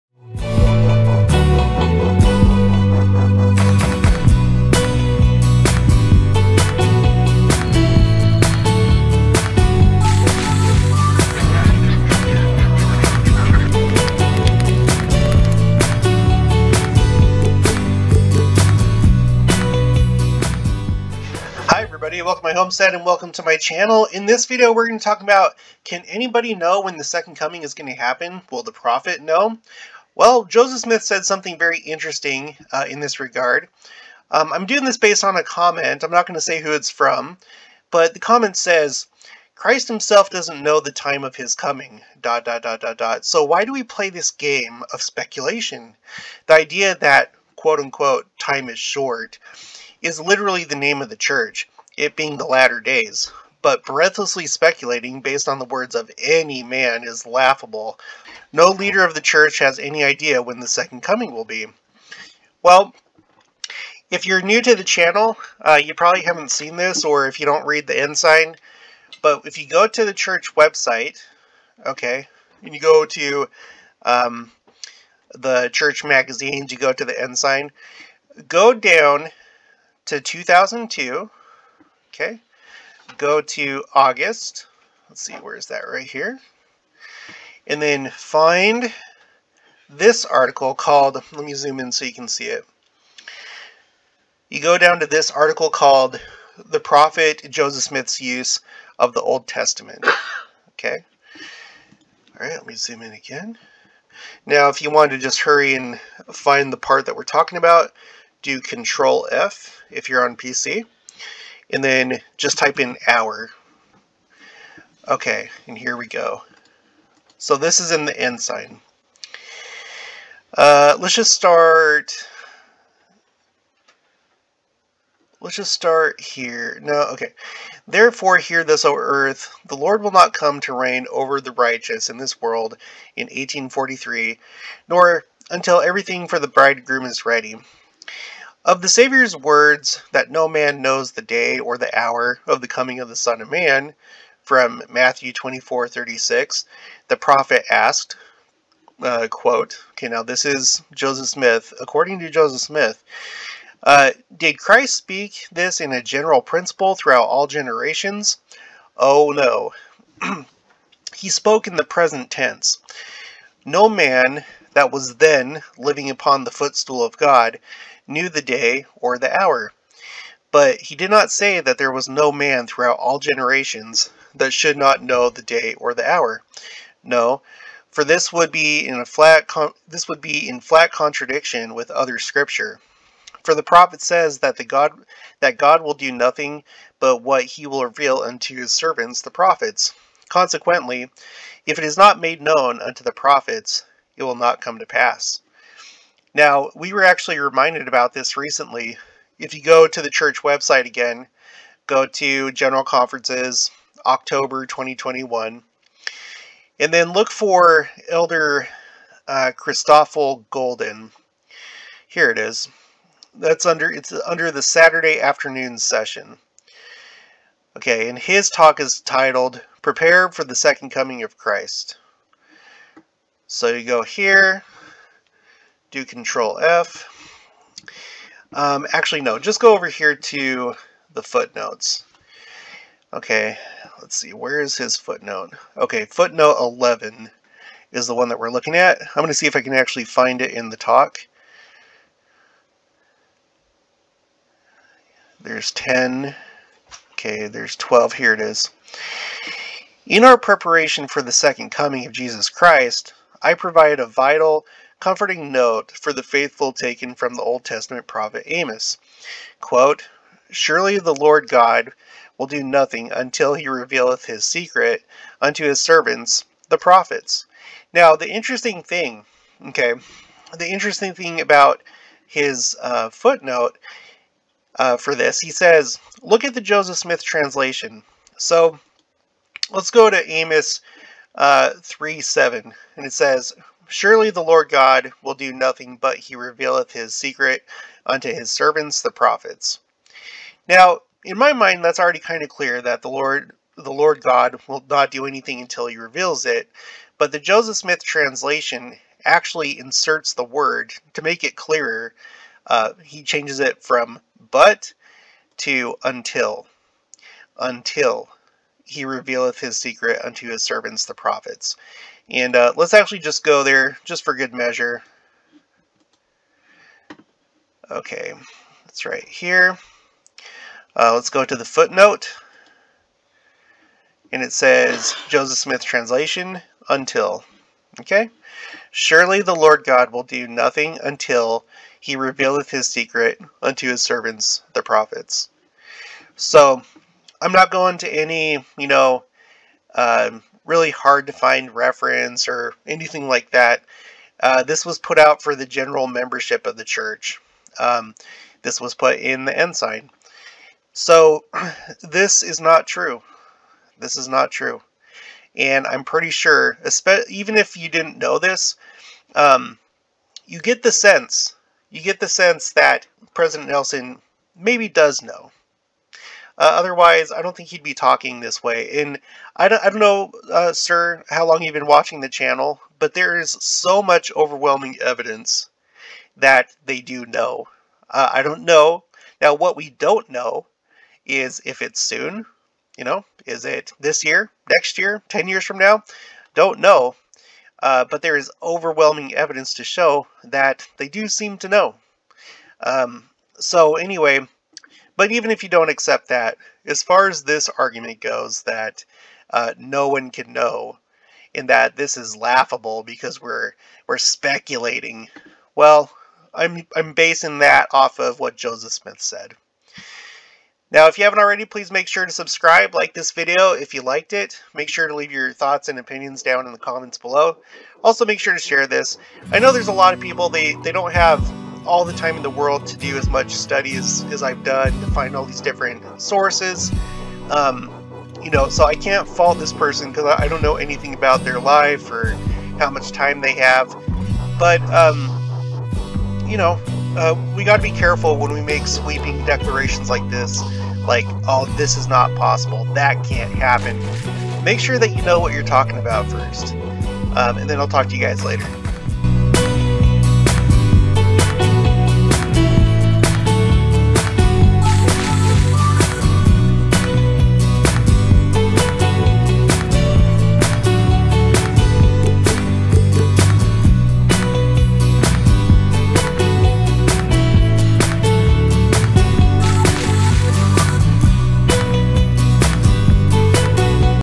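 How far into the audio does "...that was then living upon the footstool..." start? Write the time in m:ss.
2:44.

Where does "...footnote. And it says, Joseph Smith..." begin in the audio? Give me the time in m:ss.
5:21.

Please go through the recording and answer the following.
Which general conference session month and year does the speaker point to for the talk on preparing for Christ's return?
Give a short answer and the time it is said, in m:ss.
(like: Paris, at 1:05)
October 2021, at 3:24.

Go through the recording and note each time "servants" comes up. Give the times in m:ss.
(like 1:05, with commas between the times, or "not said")
3:08, 4:25, 4:48, 5:10, 5:34.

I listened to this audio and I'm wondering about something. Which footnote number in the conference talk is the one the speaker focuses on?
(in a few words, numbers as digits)
11.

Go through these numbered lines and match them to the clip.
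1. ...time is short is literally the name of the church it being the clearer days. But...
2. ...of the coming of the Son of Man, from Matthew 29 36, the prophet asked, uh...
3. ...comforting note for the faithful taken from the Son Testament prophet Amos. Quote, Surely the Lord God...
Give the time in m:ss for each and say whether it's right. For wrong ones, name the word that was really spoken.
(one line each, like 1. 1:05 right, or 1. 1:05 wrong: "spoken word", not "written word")
1. 0:48 wrong: "latter", not "clearer"
2. 2:22 wrong: "24", not "29"
3. 4:15 wrong: "Old", not "Son".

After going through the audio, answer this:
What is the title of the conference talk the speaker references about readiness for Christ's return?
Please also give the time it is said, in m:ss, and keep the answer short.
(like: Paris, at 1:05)
Prepare for the Second Coming of Christ, at 3:39.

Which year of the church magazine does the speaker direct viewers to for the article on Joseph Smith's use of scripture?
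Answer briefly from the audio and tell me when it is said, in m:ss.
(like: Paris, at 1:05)
2002, at 1:20.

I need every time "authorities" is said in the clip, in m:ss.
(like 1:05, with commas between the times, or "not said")
not said.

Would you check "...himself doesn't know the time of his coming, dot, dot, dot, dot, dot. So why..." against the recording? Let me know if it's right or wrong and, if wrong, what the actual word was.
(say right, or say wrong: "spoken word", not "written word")
right.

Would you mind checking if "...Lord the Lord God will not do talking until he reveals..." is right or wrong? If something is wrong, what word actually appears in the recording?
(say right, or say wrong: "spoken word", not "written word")
wrong: "anything", not "talking".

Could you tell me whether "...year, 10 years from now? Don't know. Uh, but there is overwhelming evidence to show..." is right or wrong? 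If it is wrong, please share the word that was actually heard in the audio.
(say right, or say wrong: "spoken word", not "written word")
right.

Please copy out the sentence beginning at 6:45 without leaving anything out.
Well, I'm I'm basing that off of what Joseph Smith said.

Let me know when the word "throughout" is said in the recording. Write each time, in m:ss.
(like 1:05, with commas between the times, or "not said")
2:36, 2:52.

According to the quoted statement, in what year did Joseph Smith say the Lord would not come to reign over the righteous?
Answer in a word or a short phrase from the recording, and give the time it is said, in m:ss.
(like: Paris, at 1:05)
1843, at 2:13.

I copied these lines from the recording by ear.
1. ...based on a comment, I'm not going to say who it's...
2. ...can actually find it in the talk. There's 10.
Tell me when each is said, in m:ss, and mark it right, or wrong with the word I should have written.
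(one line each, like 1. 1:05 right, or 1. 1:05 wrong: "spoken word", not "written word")
1. 0:34 right
2. 3:59 right.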